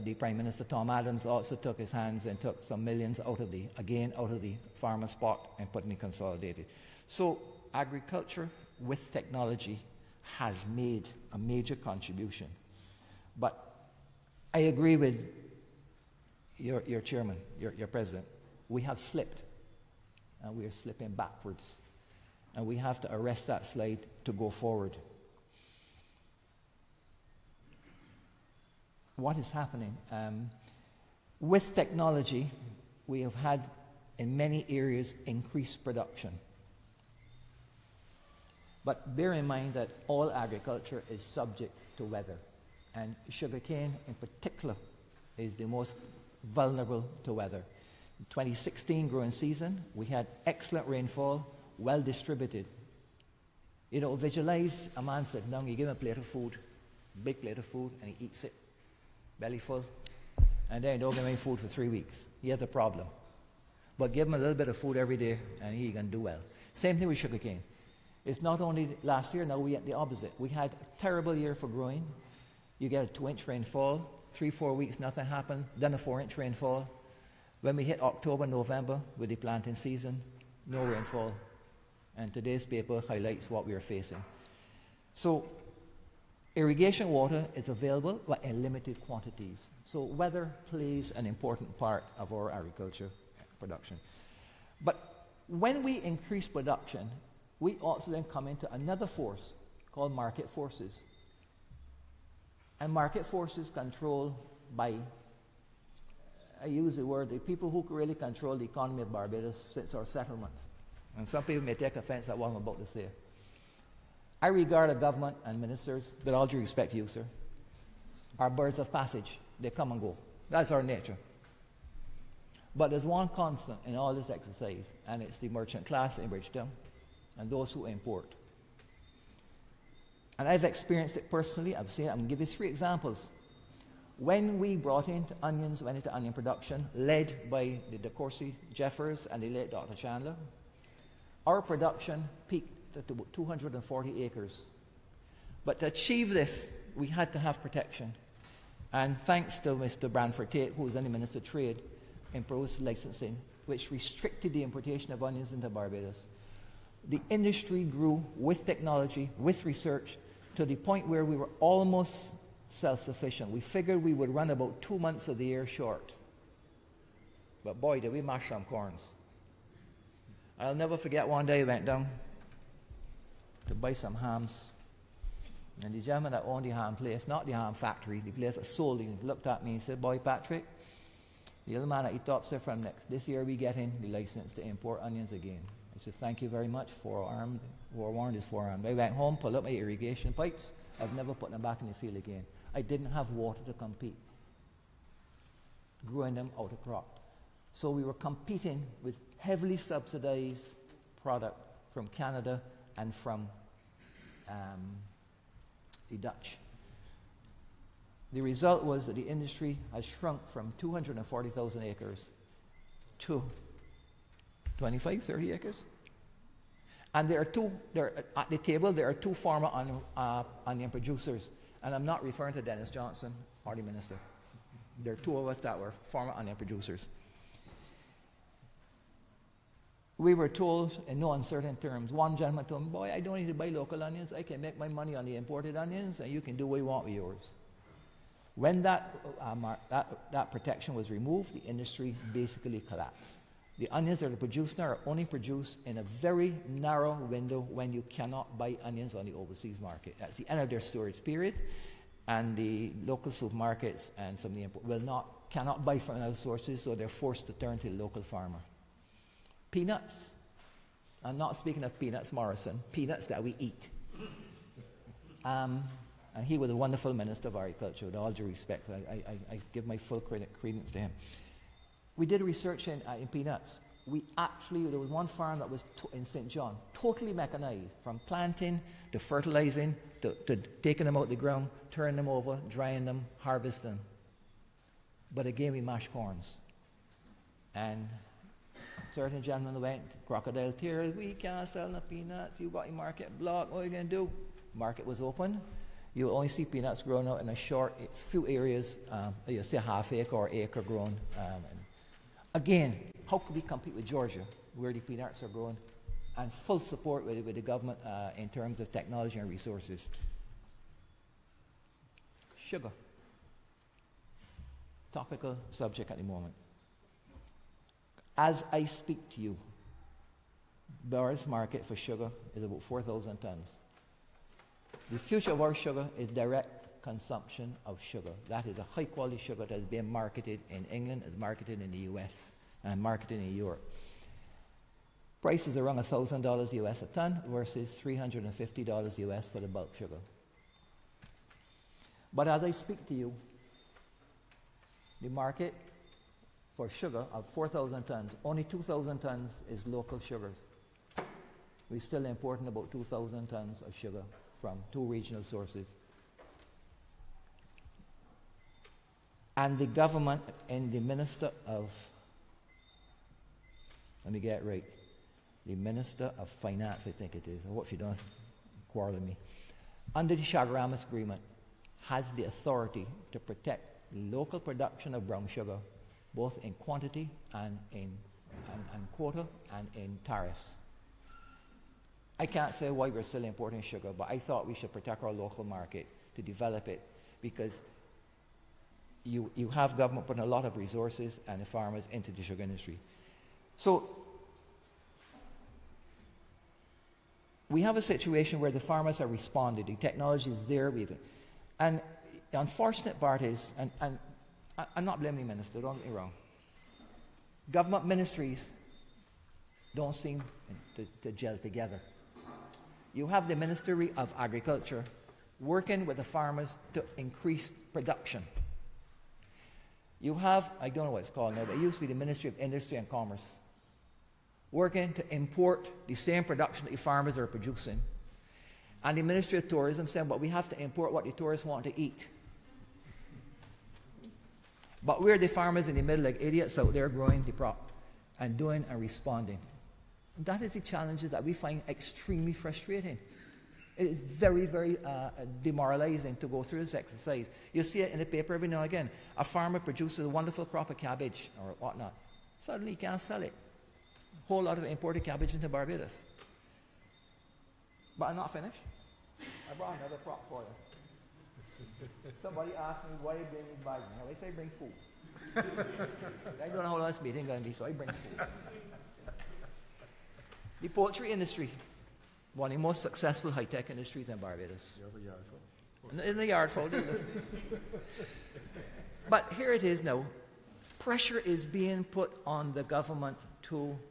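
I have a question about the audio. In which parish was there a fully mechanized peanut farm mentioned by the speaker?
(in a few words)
St. John.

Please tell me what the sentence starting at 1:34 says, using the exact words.
But when we increase production, we also then come into another force called market forces.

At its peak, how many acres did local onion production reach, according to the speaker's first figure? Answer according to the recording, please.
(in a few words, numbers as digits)
240 acres.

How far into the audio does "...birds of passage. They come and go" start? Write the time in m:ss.
1:58.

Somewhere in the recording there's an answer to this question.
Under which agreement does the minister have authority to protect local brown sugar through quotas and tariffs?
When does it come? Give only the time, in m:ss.
6:10.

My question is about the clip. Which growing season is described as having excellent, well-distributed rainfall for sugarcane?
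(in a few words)
2016.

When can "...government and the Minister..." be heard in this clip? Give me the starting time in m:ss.
5:59.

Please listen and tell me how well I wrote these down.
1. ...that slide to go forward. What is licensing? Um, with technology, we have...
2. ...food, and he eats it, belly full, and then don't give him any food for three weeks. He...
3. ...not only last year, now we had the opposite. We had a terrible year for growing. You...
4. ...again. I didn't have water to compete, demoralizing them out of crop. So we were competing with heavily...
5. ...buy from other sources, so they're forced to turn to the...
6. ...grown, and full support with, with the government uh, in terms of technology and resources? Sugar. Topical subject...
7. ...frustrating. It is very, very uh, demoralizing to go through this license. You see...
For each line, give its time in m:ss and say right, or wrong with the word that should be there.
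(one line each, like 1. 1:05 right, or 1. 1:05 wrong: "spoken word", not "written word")
1. 0:23 wrong: "happening", not "licensing"
2. 0:57 right
3. 1:08 right
4. 3:12 wrong: "growing", not "demoralizing"
5. 4:15 right
6. 5:05 right
7. 7:22 wrong: "exercise", not "license".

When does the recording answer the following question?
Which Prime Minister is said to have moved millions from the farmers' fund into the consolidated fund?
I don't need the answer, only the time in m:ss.
0:00.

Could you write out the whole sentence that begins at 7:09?
And the Ministry of Tourism saying, but we have to import what the tourists want to eat.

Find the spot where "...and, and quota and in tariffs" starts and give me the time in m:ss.
6:18.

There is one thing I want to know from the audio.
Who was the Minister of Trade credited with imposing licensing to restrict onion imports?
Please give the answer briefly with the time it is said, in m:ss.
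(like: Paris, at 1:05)
Branford Taitt, at 2:29.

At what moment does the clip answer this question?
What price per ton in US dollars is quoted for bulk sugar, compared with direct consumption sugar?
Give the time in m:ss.
5:38.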